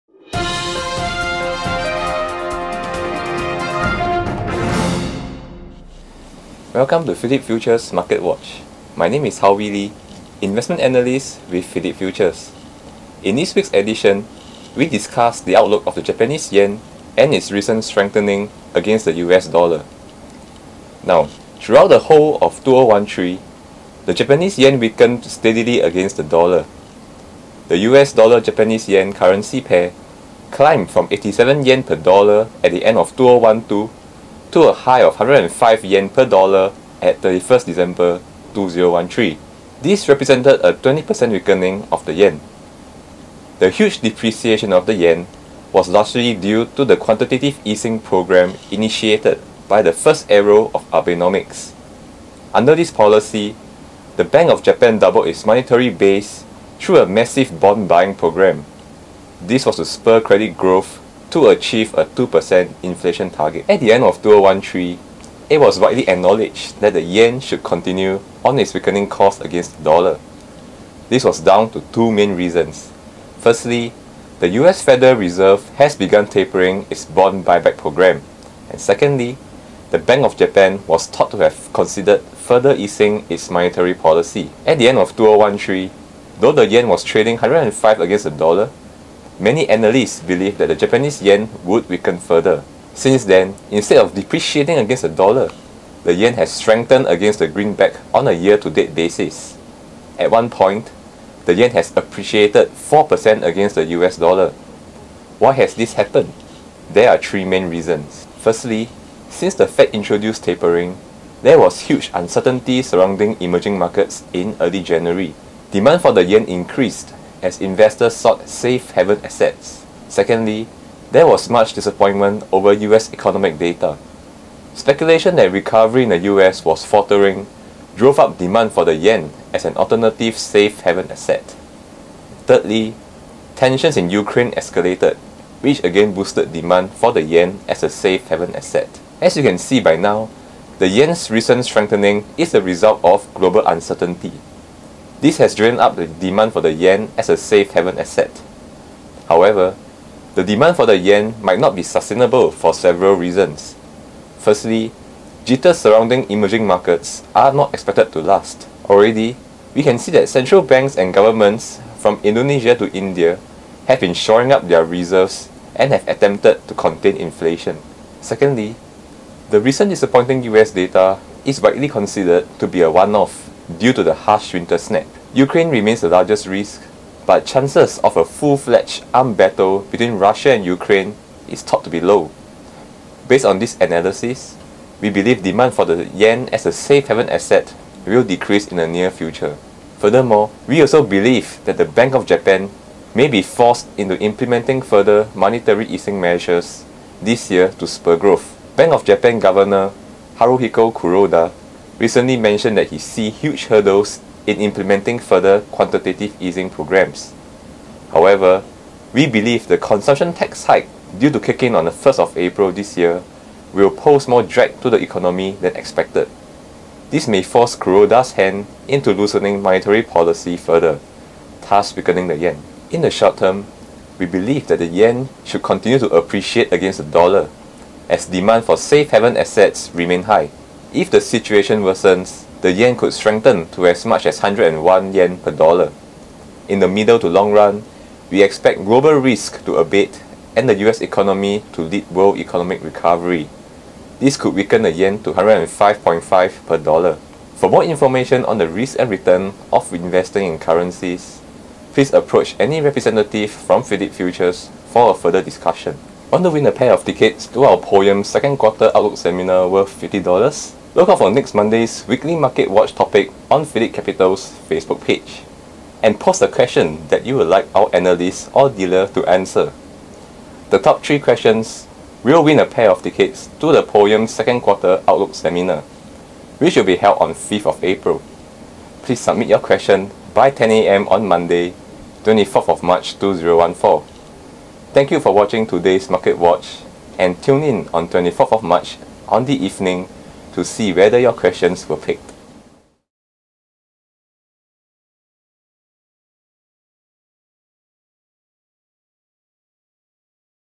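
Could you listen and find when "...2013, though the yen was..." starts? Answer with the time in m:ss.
1:25.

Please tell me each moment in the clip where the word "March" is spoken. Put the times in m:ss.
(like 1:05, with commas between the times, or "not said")
4:42, 4:48.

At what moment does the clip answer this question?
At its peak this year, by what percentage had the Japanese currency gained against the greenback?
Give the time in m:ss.
1:42.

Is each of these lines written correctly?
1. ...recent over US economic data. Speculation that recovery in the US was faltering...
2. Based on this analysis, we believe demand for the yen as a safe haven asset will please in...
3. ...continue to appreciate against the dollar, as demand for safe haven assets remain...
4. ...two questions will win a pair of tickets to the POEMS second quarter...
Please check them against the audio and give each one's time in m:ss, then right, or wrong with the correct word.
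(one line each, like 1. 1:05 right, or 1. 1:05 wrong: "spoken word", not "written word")
1. 2:01 wrong: "disappointment", not "recent"
2. 3:03 wrong: "decrease", not "please"
3. 3:45 right
4. 4:31 wrong: "three", not "two".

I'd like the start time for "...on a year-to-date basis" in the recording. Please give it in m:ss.
1:38.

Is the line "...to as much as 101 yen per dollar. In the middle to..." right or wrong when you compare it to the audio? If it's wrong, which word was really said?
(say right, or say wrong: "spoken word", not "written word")
right.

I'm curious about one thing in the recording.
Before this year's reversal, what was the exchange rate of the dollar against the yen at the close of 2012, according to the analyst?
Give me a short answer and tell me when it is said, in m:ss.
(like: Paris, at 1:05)
87 yen per dollar, at 0:31.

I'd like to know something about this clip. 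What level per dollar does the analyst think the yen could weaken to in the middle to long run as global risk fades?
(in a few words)
105.5.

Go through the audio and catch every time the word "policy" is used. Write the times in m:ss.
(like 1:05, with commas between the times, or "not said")
0:52, 1:23, 3:40.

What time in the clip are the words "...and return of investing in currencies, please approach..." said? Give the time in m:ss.
4:08.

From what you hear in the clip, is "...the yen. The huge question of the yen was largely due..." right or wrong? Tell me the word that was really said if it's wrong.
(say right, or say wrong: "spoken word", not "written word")
wrong: "depreciation", not "question".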